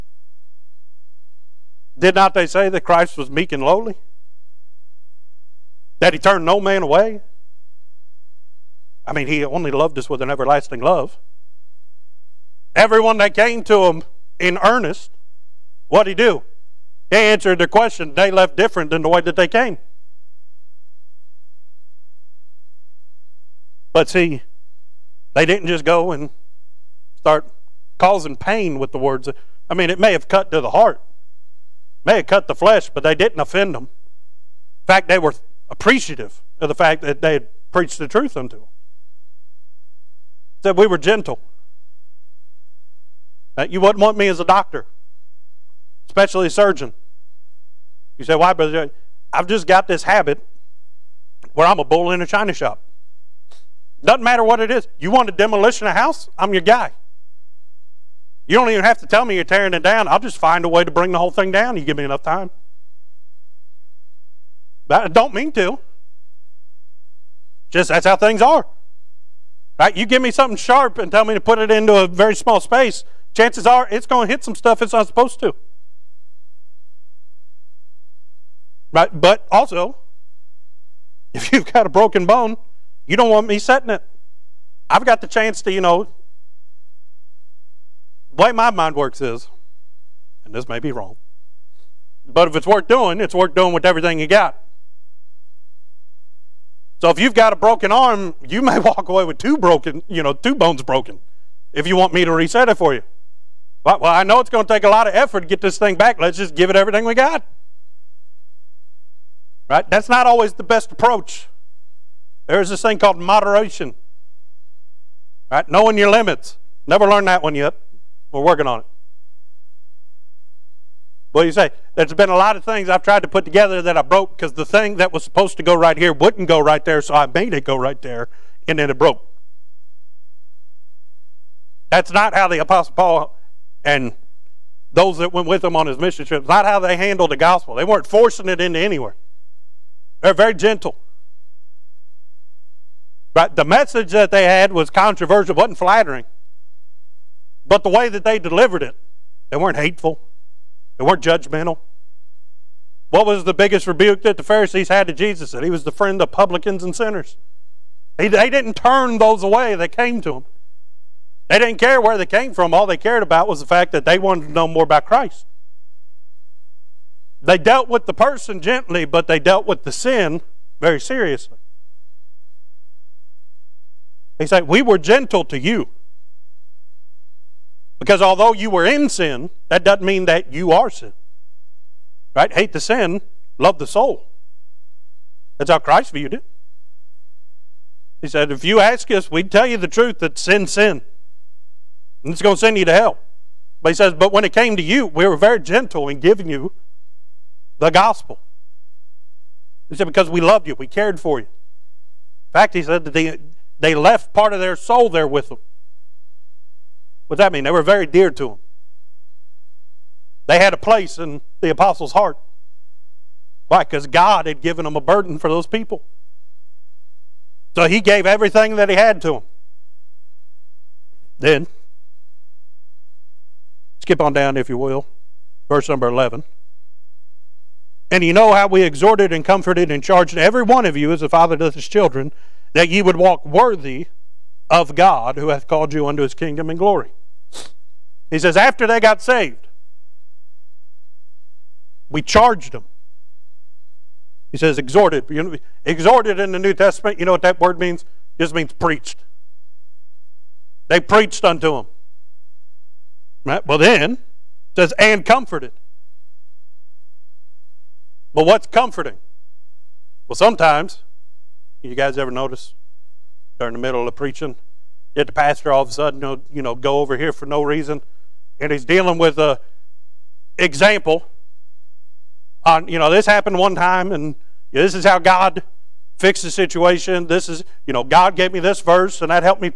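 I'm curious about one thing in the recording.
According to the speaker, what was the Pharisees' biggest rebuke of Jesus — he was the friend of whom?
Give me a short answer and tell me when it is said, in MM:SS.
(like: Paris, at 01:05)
publicans and sinners, at 02:36.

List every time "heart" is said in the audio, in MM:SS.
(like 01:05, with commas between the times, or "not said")
00:30, 03:32.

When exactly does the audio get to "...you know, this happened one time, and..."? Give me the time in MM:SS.
04:32.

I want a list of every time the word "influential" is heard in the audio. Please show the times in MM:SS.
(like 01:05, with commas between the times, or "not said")
not said.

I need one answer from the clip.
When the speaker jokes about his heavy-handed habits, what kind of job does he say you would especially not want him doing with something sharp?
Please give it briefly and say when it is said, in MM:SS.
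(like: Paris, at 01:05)
surgeon, at 00:46.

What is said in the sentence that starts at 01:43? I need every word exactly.
Well, I know it's going to take a lot of effort to get this thing back.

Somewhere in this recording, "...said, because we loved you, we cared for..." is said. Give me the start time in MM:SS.
03:19.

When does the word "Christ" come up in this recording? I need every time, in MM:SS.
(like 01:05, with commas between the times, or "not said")
00:02, 02:45, 03:05.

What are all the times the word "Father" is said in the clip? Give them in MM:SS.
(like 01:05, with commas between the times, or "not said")
03:51.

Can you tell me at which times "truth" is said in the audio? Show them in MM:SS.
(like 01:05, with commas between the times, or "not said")
00:38, 03:09.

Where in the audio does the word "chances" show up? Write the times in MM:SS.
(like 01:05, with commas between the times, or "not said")
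01:13, 01:25.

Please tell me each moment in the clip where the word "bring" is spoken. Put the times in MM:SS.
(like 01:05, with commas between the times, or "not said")
01:00.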